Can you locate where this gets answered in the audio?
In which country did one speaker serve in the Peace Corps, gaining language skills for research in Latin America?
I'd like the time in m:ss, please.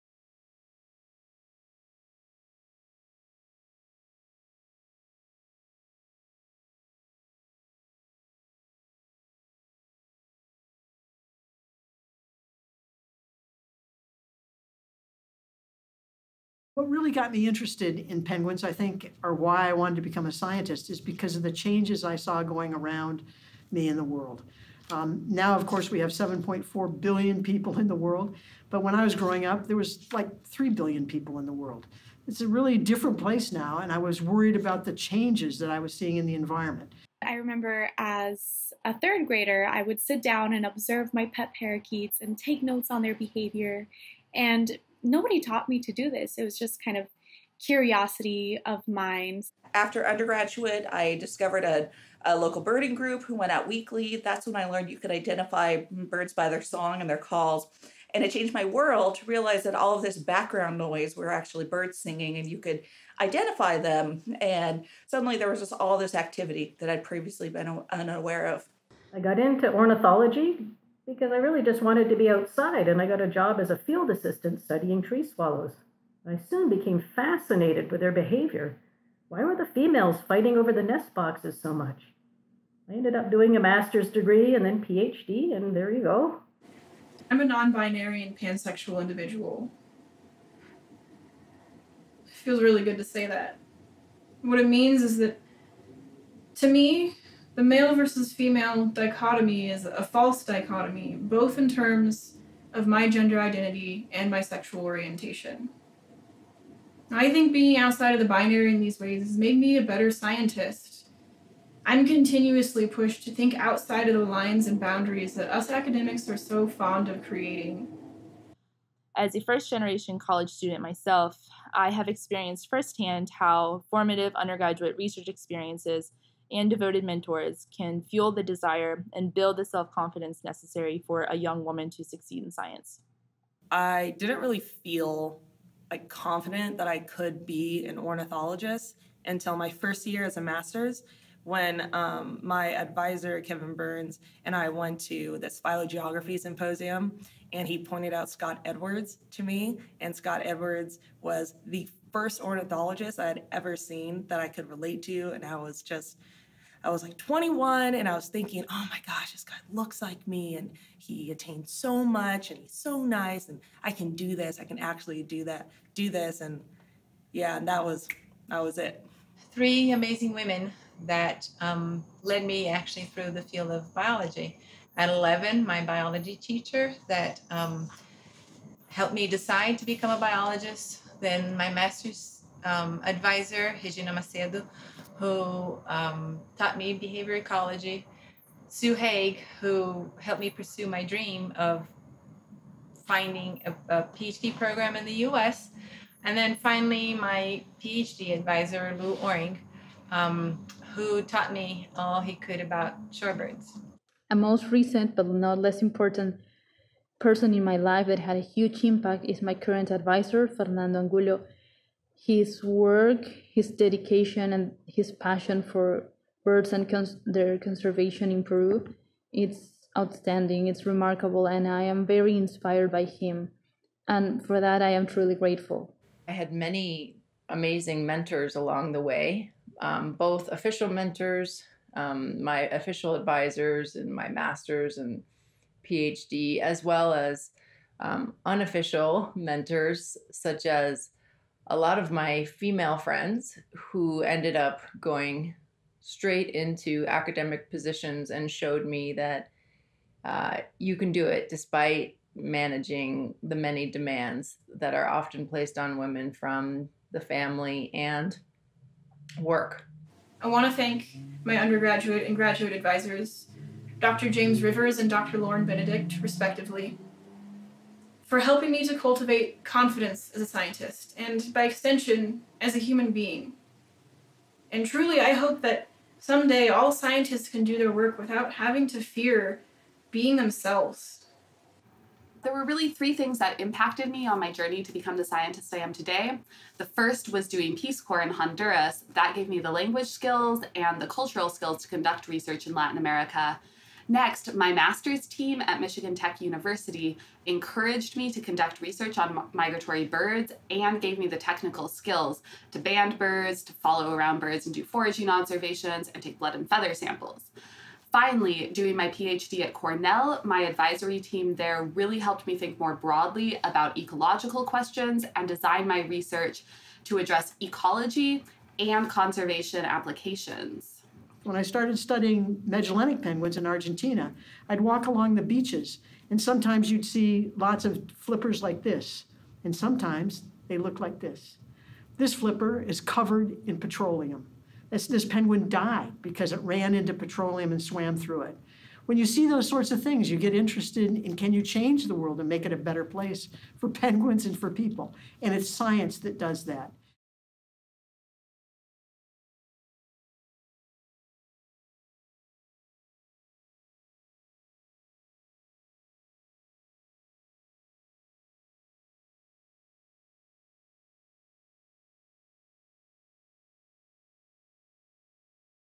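4:48.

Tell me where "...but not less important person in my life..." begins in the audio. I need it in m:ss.
3:25.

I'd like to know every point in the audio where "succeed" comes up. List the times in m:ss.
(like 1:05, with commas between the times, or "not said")
2:12.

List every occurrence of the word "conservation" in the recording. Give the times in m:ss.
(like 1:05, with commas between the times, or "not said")
3:37, 5:19.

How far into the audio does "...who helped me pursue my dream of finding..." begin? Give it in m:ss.
3:09.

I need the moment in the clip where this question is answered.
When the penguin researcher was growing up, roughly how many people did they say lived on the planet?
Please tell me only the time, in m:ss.
0:30.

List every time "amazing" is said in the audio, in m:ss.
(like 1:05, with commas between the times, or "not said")
2:49, 3:47.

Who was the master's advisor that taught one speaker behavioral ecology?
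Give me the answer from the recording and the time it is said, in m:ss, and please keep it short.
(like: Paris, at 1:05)
Regina Macedo, at 3:03.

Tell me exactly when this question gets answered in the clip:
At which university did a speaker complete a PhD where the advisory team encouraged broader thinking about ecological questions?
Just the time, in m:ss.
5:09.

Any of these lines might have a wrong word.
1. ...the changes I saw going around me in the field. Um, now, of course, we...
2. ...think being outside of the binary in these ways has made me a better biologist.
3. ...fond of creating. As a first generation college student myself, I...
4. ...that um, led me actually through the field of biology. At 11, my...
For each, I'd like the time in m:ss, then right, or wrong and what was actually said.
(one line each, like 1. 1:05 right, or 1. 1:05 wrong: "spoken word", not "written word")
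1. 0:21 wrong: "world", not "field"
2. 1:47 wrong: "scientist", not "biologist"
3. 1:56 right
4. 2:51 right.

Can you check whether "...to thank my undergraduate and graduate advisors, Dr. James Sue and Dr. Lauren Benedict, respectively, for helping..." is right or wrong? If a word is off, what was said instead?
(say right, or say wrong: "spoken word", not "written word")
wrong: "Rivers", not "Sue".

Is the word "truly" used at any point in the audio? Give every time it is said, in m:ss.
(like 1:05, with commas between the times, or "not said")
3:45, 4:34.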